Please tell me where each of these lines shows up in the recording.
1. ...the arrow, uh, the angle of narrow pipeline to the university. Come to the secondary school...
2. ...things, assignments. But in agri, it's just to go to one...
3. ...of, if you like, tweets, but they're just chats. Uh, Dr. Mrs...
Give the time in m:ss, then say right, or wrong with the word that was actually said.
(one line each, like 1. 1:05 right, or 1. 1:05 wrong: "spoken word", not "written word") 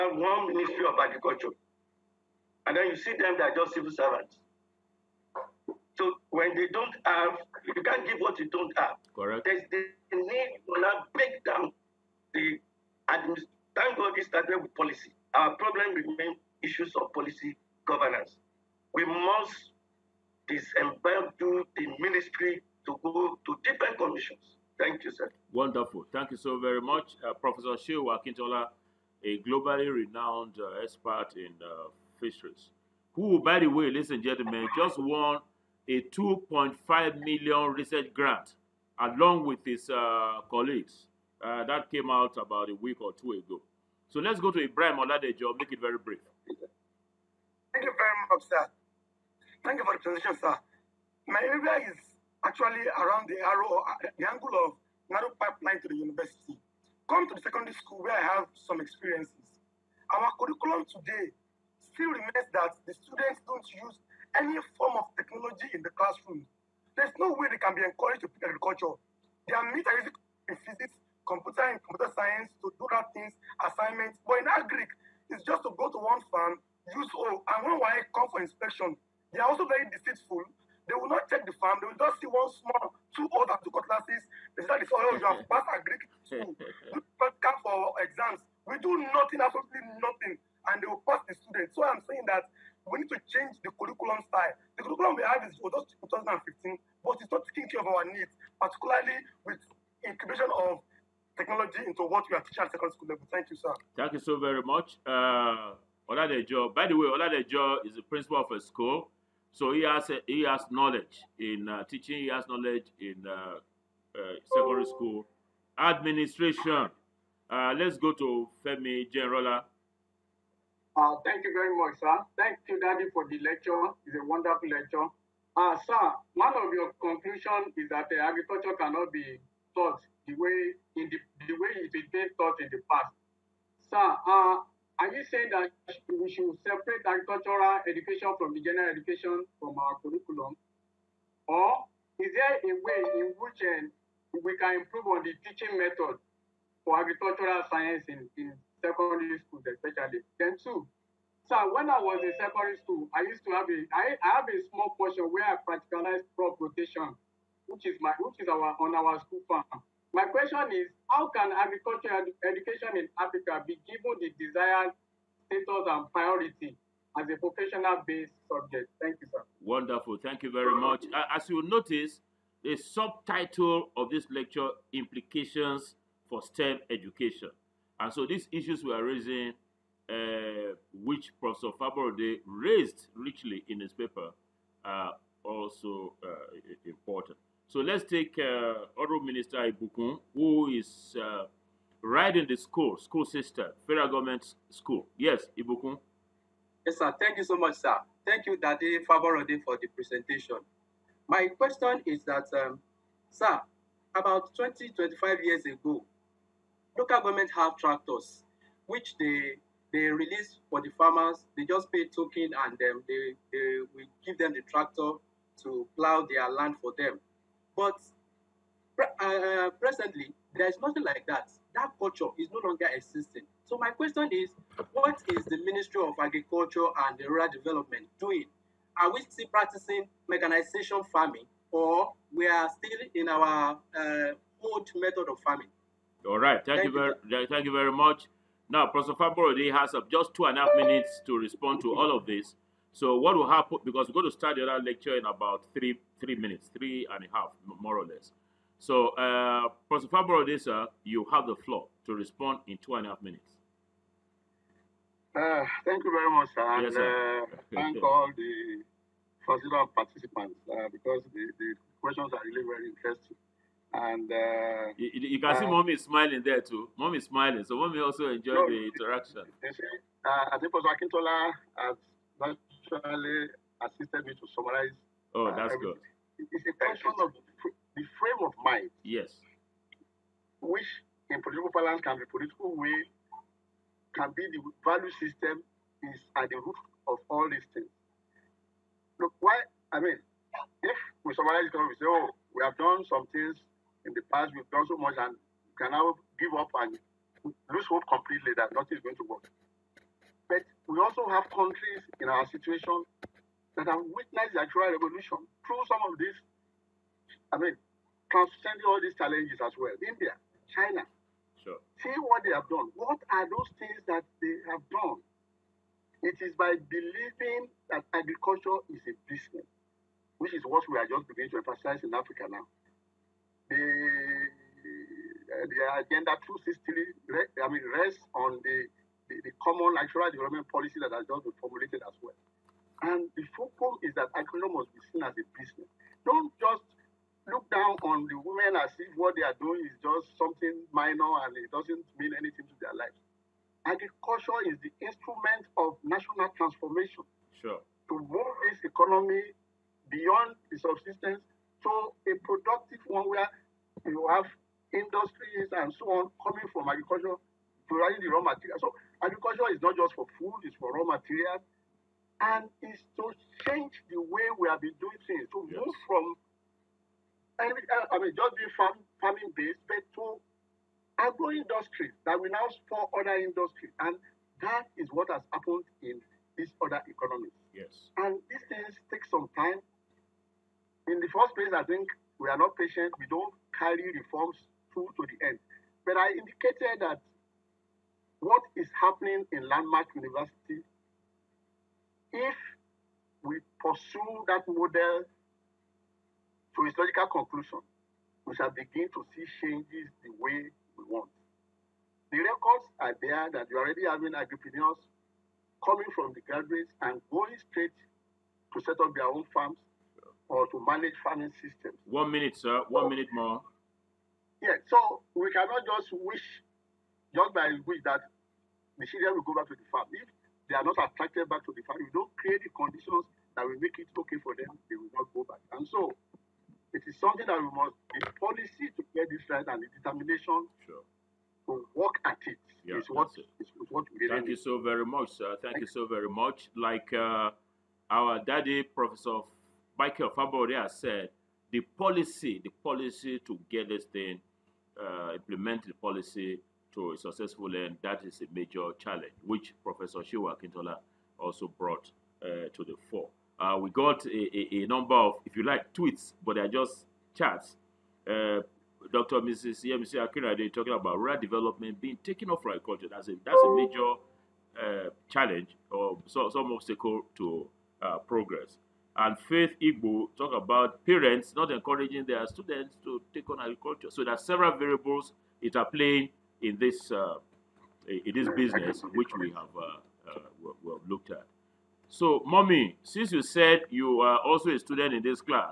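1. 0:53 right
2. 1:13 right
3. 7:35 right.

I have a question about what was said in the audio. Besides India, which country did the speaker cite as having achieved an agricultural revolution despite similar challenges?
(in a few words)
China.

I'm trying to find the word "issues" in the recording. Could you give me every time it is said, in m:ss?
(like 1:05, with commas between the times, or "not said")
0:16, 2:58.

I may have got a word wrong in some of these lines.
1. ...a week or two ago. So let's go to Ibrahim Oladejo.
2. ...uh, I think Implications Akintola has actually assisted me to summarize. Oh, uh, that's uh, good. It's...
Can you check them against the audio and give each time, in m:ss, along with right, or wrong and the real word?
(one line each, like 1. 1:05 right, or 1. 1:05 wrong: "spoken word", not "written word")
1. 0:42 right
2. 4:30 wrong: "Professor", not "Implications".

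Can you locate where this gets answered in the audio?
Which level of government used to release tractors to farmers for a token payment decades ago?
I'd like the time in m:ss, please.
3:26.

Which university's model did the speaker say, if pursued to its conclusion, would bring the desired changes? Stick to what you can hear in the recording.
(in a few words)
Landmark University.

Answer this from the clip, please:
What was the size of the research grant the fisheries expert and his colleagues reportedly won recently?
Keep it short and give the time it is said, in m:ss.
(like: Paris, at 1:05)
2.5 million, at 0:36.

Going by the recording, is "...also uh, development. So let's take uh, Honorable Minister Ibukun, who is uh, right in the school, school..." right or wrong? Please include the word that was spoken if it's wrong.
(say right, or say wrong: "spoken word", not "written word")
wrong: "important", not "development".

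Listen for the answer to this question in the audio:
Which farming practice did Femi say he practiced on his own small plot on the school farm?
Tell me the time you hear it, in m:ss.
2:36.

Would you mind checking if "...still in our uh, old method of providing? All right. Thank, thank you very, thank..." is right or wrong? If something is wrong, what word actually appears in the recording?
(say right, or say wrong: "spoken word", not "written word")
wrong: "farming", not "providing".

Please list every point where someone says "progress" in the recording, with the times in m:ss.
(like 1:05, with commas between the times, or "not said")
7:48.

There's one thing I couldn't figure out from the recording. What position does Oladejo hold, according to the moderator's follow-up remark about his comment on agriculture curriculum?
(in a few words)
principal.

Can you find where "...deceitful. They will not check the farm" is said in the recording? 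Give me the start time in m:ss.
1:19.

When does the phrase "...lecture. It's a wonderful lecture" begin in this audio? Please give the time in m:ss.
2:03.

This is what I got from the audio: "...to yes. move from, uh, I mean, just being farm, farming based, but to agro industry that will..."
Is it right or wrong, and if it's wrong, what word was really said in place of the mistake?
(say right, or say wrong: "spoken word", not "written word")
right.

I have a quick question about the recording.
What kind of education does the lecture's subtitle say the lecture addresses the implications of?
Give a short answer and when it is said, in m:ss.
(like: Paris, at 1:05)
STEM education, at 2:56.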